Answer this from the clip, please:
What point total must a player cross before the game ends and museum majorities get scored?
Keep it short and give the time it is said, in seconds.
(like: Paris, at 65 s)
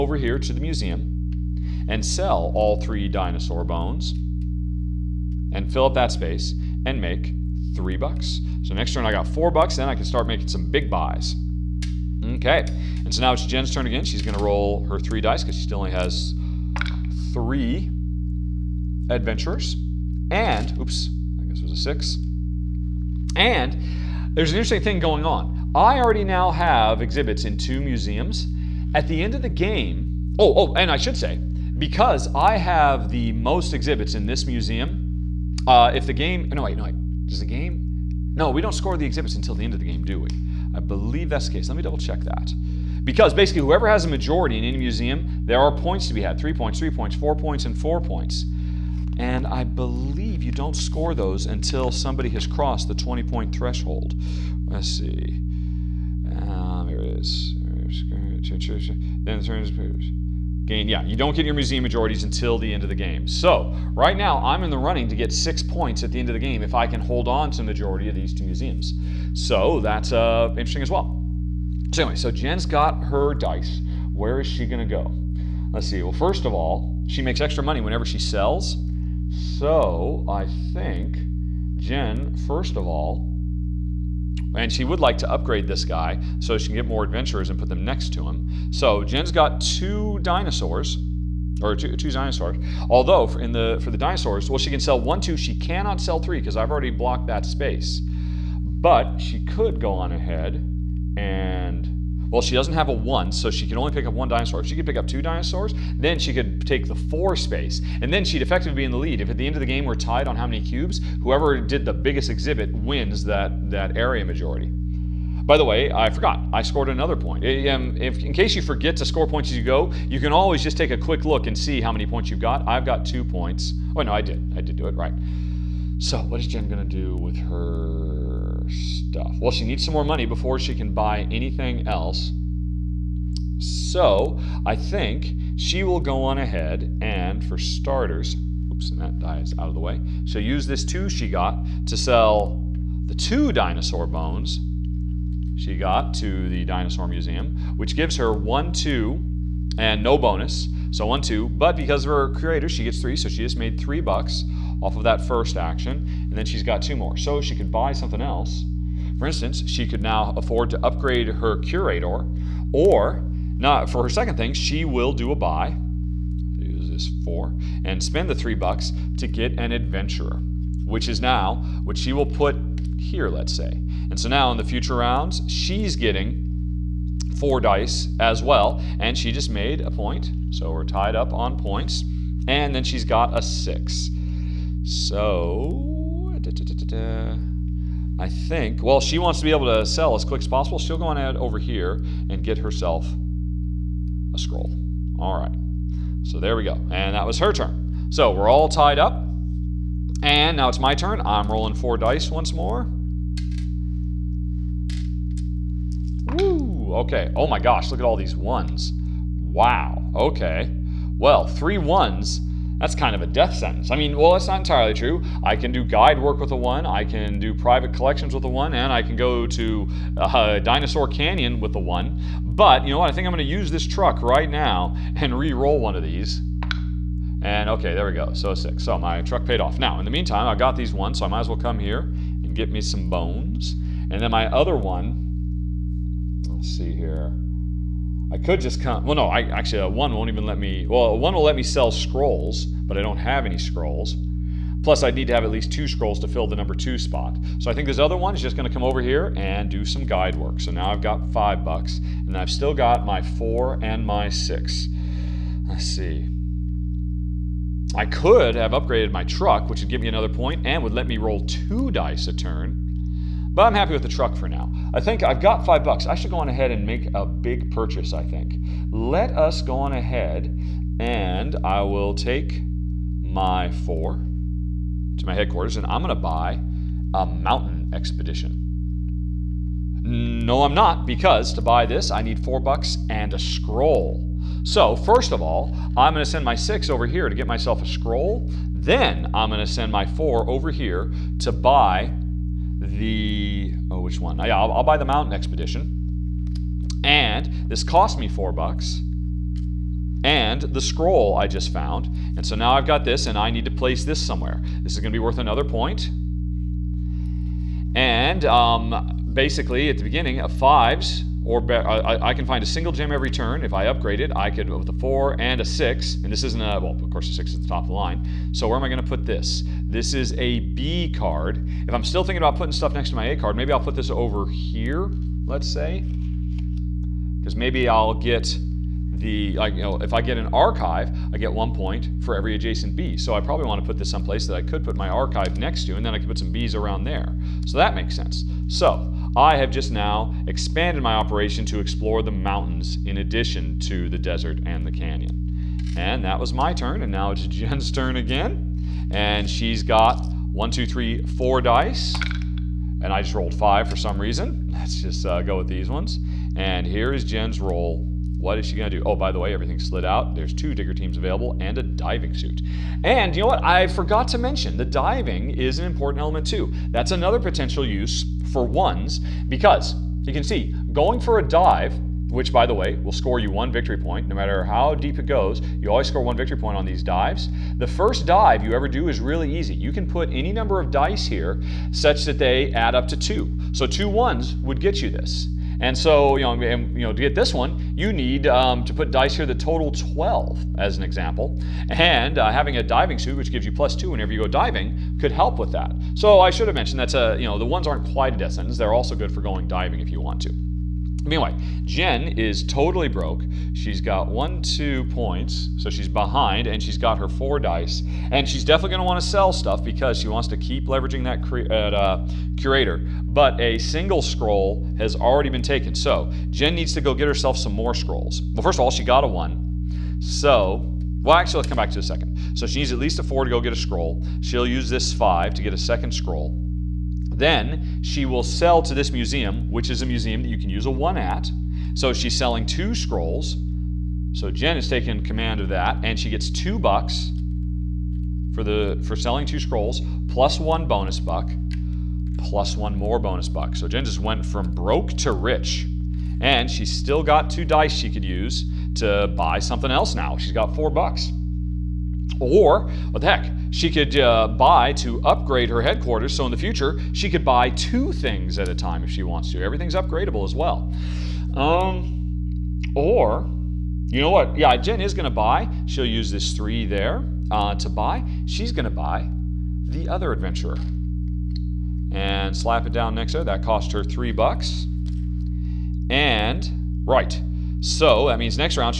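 20, at 52 s.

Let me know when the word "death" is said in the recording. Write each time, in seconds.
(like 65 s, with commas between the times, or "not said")
213 s, 398 s.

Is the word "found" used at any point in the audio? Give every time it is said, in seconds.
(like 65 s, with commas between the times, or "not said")
301 s.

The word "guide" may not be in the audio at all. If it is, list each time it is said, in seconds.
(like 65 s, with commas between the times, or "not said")
215 s, 250 s.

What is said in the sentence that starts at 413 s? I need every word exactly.
But a single scroll has already been taken.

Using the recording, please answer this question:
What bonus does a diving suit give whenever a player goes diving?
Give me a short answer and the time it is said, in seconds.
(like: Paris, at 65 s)
plus 2, at 393 s.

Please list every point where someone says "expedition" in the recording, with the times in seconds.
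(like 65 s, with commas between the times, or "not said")
277 s, 295 s.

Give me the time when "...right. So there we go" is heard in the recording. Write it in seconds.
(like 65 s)
195 s.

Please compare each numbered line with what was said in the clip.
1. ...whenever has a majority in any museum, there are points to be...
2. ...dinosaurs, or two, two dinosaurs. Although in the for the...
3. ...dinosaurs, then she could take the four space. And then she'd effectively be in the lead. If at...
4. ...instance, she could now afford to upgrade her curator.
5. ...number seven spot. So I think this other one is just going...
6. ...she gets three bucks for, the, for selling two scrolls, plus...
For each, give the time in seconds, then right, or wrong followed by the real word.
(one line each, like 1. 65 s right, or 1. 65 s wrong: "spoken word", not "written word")
1. 43 s wrong: "whoever", not "whenever"
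2. 90 s right
3. 105 s right
4. 159 s right
5. 246 s wrong: "two", not "seven"
6. 436 s wrong: "two", not "three".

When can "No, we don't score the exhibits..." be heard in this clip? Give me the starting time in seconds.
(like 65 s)
38 s.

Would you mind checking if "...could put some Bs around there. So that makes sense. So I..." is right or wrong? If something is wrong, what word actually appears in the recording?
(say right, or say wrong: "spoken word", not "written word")
right.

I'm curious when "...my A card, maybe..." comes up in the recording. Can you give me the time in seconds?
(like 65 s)
323 s.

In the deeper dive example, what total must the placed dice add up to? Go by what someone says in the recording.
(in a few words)
12.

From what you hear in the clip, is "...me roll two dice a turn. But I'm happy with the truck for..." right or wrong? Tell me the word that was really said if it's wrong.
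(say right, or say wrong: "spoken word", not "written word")
right.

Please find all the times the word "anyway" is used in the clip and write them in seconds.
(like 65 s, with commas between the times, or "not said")
72 s.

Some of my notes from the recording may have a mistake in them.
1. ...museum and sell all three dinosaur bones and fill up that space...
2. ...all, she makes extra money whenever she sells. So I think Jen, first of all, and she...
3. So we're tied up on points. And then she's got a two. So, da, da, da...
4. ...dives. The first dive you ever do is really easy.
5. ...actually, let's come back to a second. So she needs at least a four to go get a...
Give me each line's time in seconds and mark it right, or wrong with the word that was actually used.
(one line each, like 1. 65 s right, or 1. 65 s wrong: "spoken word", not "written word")
1. 0 s right
2. 76 s right
3. 180 s wrong: "six", not "two"
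4. 377 s right
5. 421 s right.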